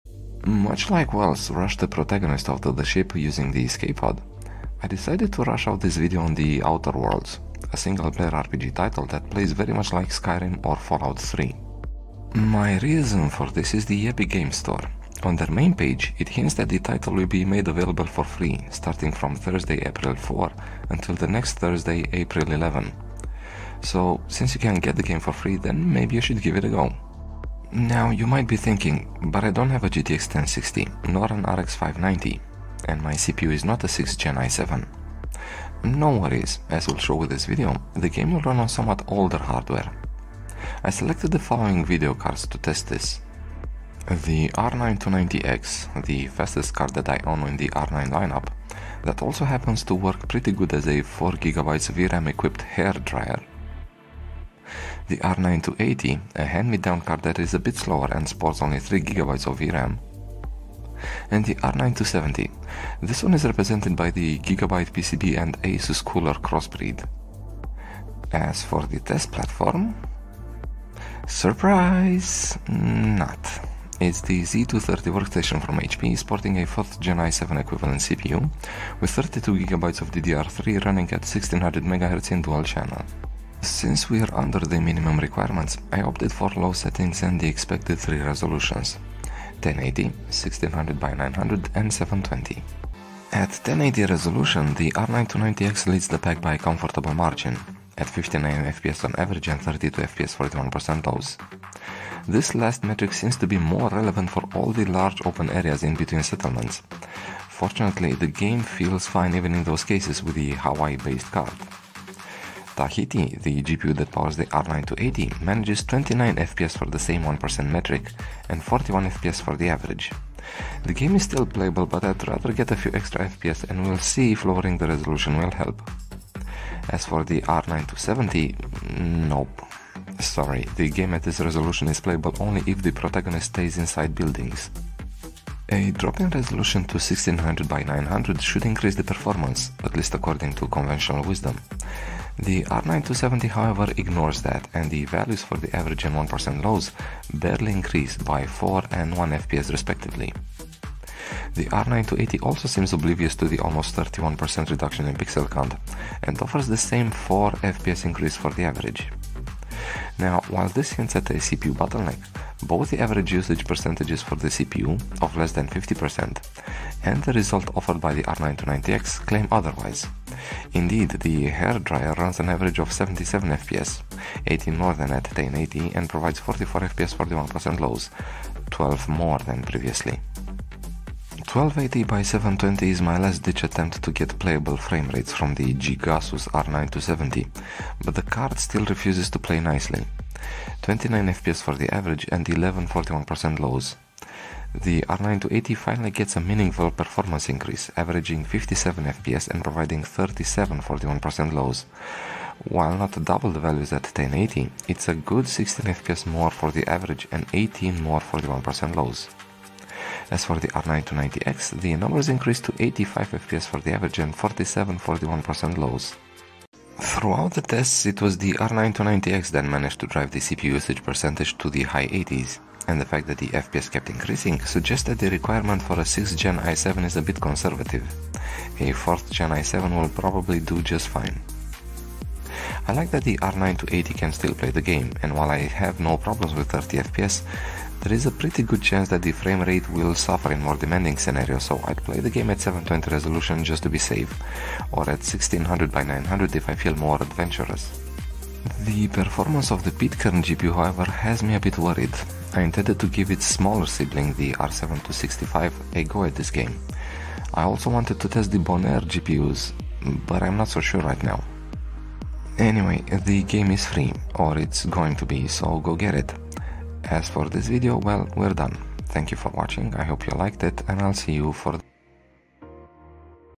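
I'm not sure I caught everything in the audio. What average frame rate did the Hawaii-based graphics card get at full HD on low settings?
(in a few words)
59 FPS.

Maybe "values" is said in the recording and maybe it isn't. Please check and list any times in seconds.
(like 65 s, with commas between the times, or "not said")
145 s, 203 s.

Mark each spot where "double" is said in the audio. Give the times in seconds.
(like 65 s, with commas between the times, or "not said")
203 s.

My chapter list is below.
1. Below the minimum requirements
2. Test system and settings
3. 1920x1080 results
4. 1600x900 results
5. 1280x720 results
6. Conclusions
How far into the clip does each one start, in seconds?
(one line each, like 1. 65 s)
1. 27 s
2. 67 s
3. 93 s
4. 135 s
5. 181 s
6. 217 s.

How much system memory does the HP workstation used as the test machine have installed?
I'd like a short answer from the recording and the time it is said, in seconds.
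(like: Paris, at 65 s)
32GB, at 79 s.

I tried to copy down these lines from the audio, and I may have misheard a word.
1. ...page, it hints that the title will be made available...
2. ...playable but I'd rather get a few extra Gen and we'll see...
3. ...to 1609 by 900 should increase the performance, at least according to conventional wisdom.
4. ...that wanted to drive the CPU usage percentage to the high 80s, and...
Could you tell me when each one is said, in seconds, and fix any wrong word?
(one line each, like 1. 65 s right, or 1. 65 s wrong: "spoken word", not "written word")
1. 15 s right
2. 121 s wrong: "FPS", not "Gen"
3. 136 s wrong: "1600", not "1609"
4. 219 s wrong: "managed", not "wanted".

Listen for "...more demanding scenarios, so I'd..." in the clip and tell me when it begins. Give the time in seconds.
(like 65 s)
240 s.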